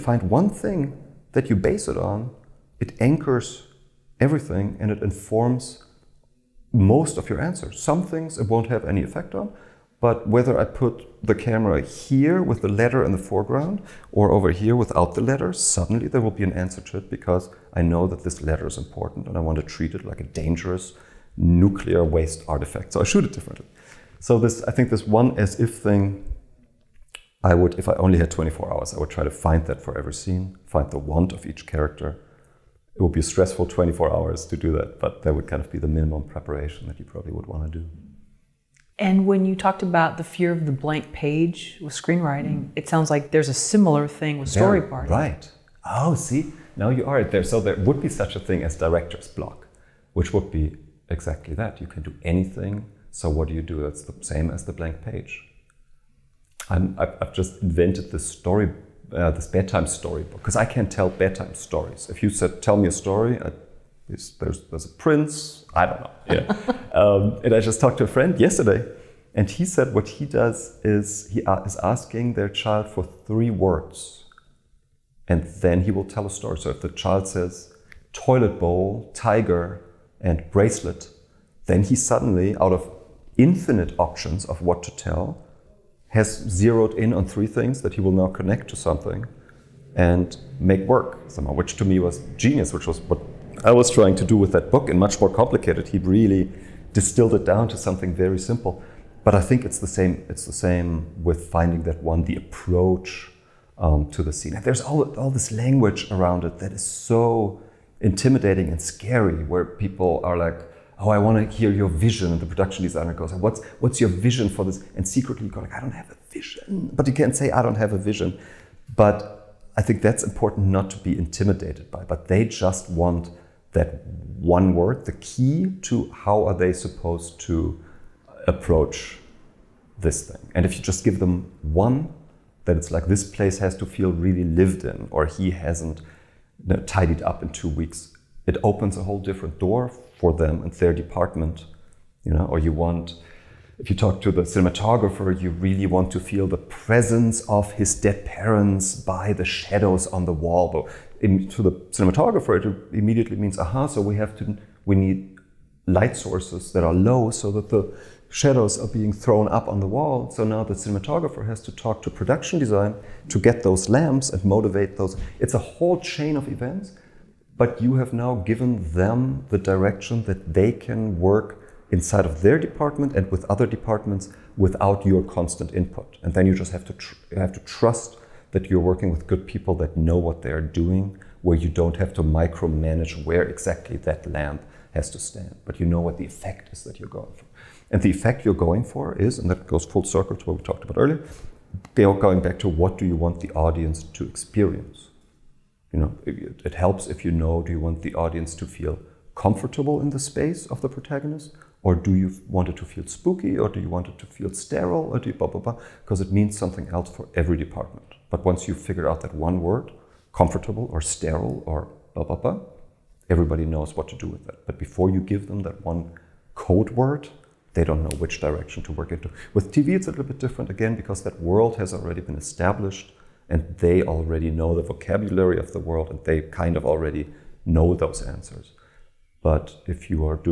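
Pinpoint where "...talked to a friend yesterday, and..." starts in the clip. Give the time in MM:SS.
01:07.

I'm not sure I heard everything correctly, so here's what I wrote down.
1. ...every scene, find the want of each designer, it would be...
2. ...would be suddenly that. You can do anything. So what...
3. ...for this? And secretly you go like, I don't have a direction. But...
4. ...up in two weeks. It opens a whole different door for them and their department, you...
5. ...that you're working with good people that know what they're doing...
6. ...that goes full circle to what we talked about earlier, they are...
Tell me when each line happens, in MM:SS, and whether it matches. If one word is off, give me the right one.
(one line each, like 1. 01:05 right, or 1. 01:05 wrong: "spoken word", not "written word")
1. 00:29 wrong: "character", not "designer"
2. 00:50 wrong: "exactly", not "suddenly"
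3. 01:54 wrong: "vision", not "direction"
4. 02:17 right
5. 02:58 right
6. 03:09 right.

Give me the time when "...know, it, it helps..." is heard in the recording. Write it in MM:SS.
03:16.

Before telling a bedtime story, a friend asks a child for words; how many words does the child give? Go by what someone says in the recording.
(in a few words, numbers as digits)
3.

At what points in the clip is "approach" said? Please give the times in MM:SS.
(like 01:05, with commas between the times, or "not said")
01:42, 02:08.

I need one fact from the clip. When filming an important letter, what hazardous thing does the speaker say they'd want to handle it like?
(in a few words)
Dangerous nuclear waste artifact.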